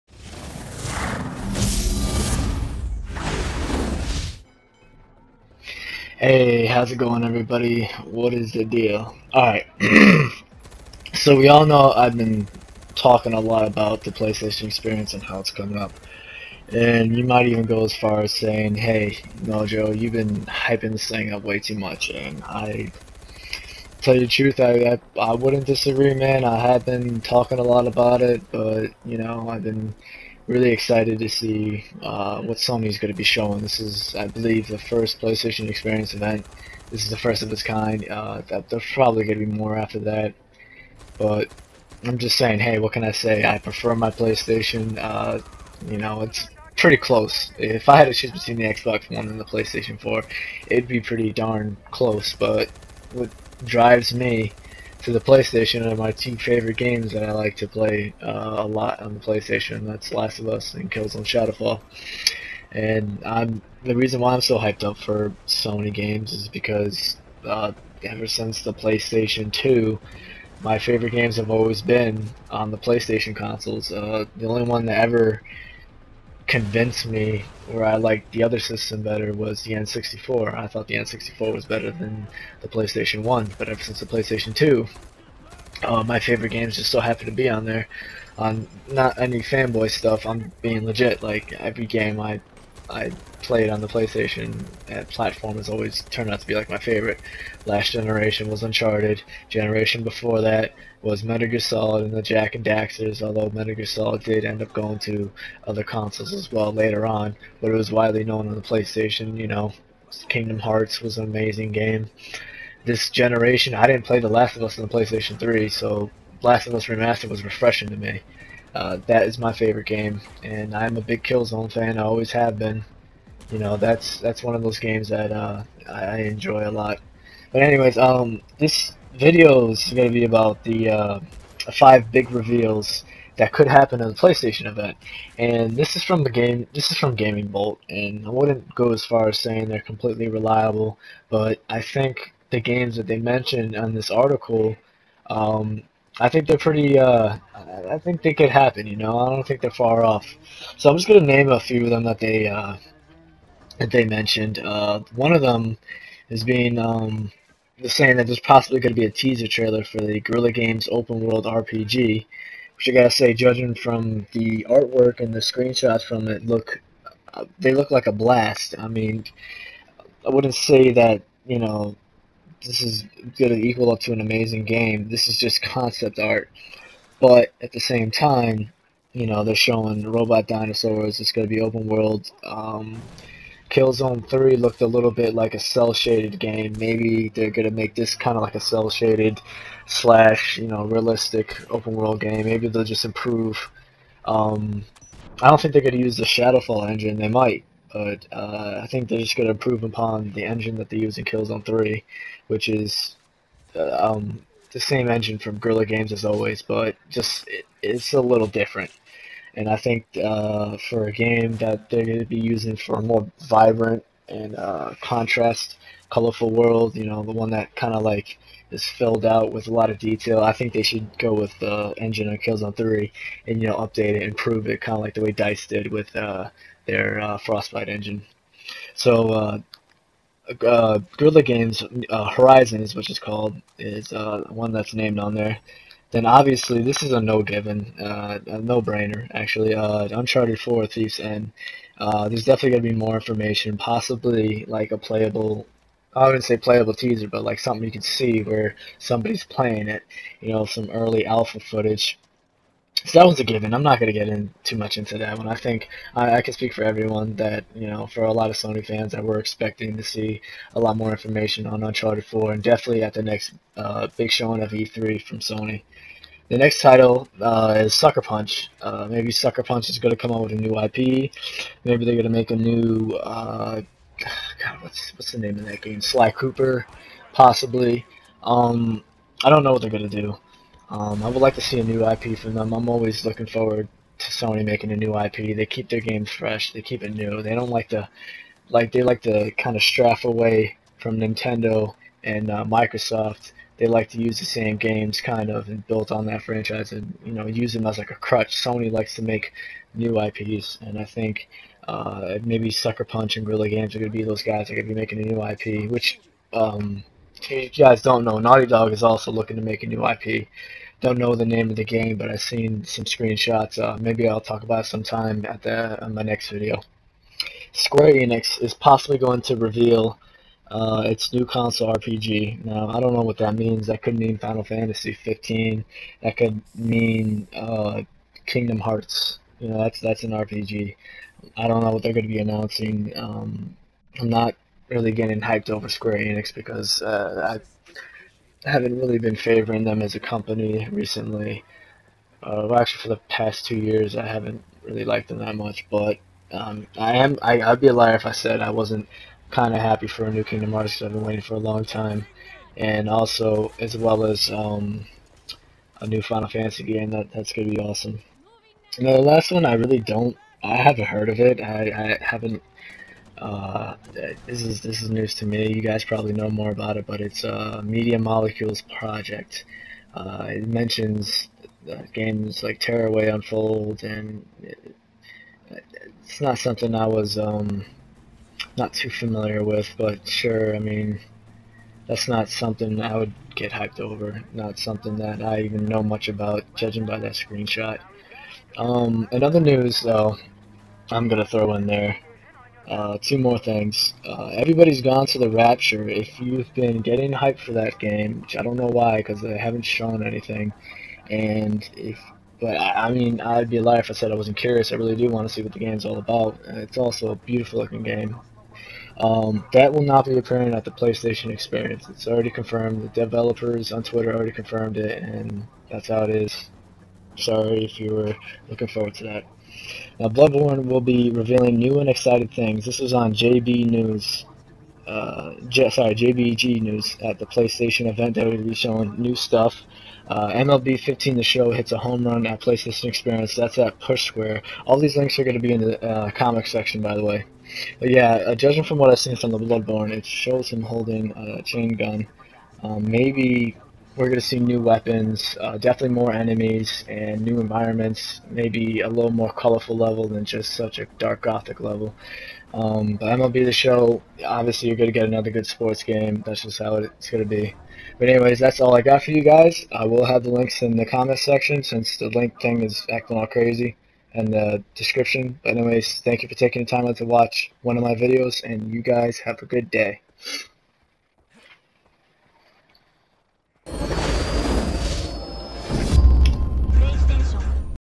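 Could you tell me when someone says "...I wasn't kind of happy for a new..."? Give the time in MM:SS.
05:48.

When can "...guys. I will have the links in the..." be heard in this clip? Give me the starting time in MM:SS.
07:39.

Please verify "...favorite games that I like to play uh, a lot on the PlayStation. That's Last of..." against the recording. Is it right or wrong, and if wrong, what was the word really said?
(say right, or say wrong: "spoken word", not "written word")
right.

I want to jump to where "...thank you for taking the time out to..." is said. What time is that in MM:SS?
07:46.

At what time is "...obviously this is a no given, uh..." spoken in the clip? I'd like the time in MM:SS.
03:56.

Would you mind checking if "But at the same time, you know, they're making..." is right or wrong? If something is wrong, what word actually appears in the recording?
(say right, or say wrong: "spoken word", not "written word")
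wrong: "showing", not "making".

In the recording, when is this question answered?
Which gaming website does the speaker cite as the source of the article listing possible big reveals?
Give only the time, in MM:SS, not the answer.
02:17.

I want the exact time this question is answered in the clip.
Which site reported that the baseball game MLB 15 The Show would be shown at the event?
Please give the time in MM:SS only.
07:13.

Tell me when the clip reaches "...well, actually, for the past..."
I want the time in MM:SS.
05:42.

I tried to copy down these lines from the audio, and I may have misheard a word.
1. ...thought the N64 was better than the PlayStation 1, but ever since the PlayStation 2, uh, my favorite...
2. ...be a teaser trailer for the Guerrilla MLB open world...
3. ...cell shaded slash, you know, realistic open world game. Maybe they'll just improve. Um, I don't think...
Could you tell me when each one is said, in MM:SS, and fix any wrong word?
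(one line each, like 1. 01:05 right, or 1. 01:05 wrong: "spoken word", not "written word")
1. 01:20 right
2. 02:38 wrong: "Games", not "MLB"
3. 03:08 right.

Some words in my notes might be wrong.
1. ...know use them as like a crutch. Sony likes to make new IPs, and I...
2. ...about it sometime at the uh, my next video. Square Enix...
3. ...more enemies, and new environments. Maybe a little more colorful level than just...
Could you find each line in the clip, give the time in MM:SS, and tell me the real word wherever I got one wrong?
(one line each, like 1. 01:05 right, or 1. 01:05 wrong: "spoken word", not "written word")
1. 04:57 right
2. 05:14 right
3. 07:26 right.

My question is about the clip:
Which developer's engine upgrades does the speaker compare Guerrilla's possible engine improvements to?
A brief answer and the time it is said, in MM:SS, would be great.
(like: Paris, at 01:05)
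Dice, at 03:45.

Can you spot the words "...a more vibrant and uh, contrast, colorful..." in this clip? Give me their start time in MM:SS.
03:32.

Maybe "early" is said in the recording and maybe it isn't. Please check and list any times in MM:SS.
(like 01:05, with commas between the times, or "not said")
04:10.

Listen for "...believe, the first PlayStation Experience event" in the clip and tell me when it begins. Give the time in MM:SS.
00:34.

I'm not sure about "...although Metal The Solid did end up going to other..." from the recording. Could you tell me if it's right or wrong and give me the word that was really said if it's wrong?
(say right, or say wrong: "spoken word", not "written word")
wrong: "Gear", not "The".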